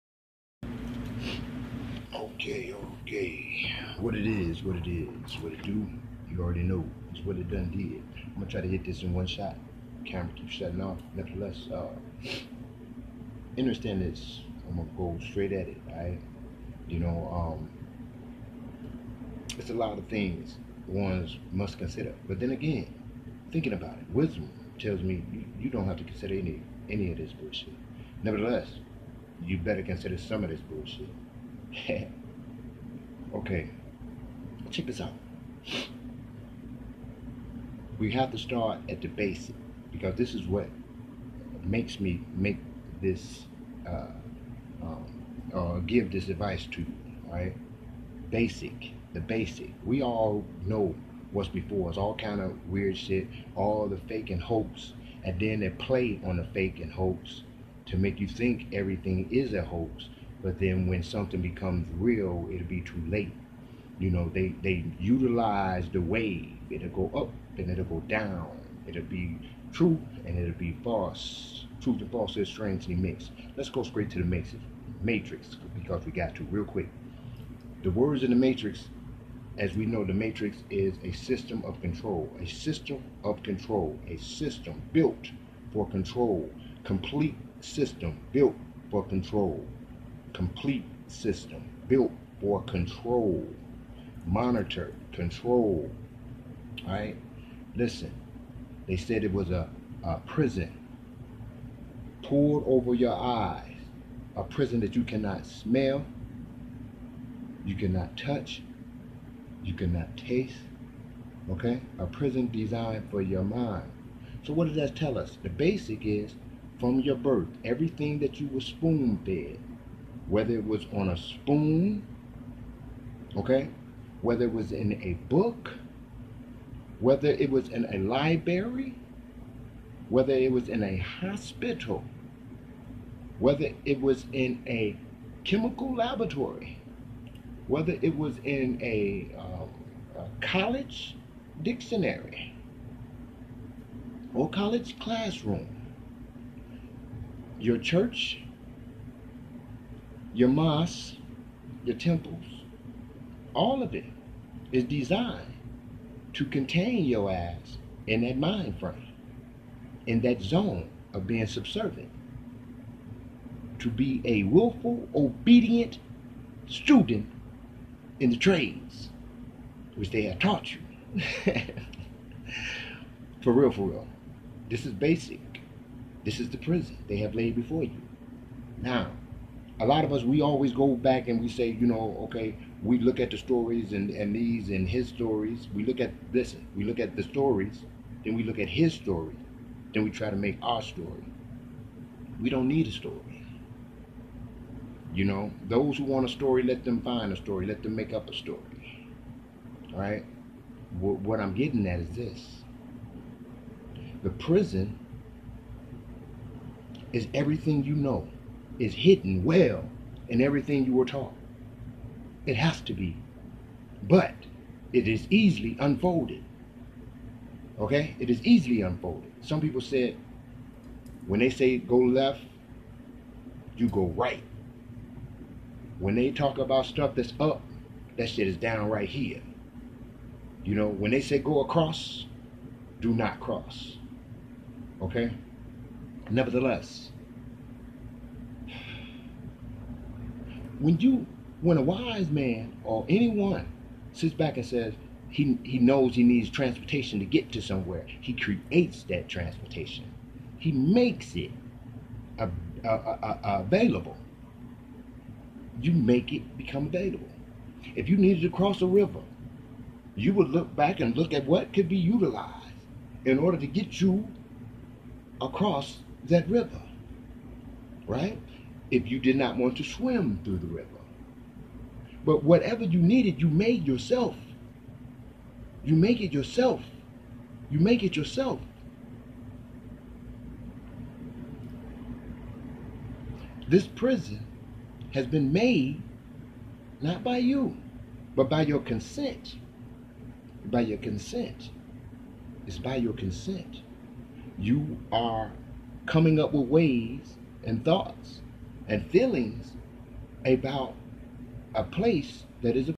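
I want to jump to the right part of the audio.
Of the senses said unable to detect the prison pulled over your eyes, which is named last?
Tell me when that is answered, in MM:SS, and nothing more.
01:49.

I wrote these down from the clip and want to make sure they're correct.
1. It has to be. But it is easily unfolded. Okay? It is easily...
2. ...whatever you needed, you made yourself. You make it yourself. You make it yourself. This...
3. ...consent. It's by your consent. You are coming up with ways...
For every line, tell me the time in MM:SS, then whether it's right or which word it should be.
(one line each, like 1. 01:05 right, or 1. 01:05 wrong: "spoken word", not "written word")
1. 03:32 right
2. 04:32 right
3. 04:50 right.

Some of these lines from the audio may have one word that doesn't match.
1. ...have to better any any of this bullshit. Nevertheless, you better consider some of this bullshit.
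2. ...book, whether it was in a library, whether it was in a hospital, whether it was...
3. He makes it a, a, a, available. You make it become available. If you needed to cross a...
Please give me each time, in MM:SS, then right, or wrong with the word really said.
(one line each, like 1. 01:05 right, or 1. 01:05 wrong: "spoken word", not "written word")
1. 00:25 wrong: "consider", not "better"
2. 02:05 right
3. 04:10 right.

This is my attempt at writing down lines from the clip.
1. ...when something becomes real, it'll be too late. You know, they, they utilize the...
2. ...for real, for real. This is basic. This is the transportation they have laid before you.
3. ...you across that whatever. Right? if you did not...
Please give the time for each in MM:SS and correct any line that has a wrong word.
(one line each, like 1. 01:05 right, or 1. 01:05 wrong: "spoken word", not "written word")
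1. 01:00 right
2. 02:53 wrong: "prison", not "transportation"
3. 04:24 wrong: "river", not "whatever".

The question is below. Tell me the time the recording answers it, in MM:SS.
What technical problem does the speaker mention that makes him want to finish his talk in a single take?
00:10.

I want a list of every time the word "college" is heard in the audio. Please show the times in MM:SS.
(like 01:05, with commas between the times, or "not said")
02:20, 02:24.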